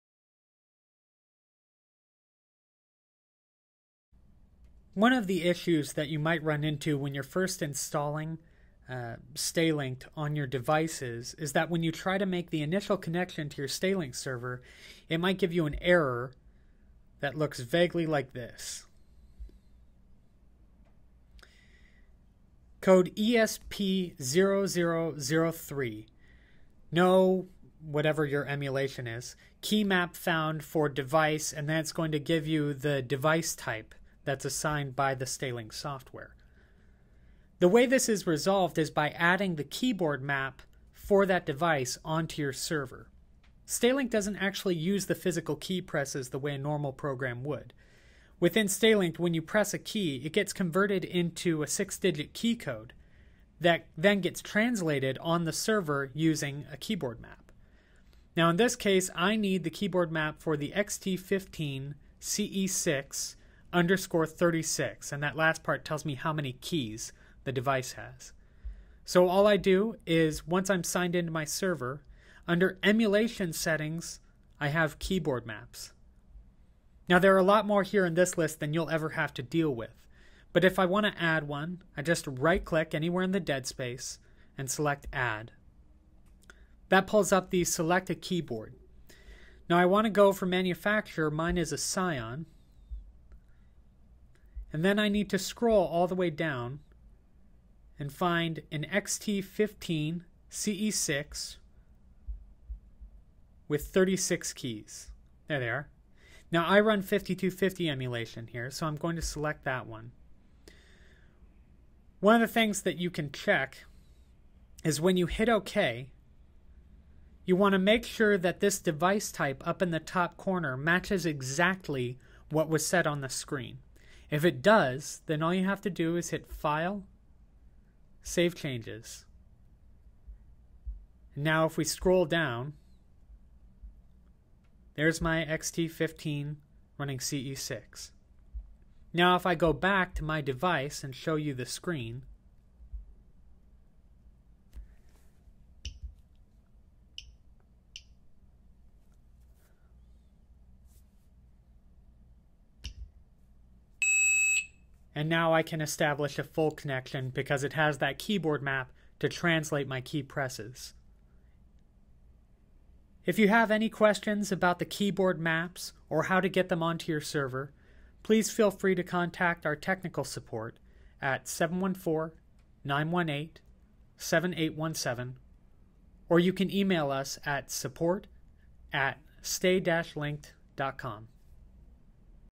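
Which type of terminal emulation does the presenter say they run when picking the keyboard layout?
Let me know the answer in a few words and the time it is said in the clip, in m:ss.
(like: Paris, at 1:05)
5250, at 1:47.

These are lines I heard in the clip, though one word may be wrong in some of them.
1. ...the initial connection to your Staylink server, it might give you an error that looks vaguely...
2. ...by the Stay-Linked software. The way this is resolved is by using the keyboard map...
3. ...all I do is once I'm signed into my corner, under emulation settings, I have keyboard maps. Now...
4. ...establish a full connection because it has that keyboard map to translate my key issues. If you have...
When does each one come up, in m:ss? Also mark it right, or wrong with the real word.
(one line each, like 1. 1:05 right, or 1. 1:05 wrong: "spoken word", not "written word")
1. 0:12 right
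2. 0:34 wrong: "adding", not "using"
3. 1:09 wrong: "server", not "corner"
4. 2:35 wrong: "presses", not "issues".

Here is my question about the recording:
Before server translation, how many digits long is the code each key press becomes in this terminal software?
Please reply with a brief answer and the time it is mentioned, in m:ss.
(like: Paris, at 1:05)
6, at 0:51.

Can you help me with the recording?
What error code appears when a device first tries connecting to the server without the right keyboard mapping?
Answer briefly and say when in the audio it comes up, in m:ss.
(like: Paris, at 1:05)
ESP0003, at 0:23.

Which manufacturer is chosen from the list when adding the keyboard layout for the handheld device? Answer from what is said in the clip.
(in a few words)
Psion.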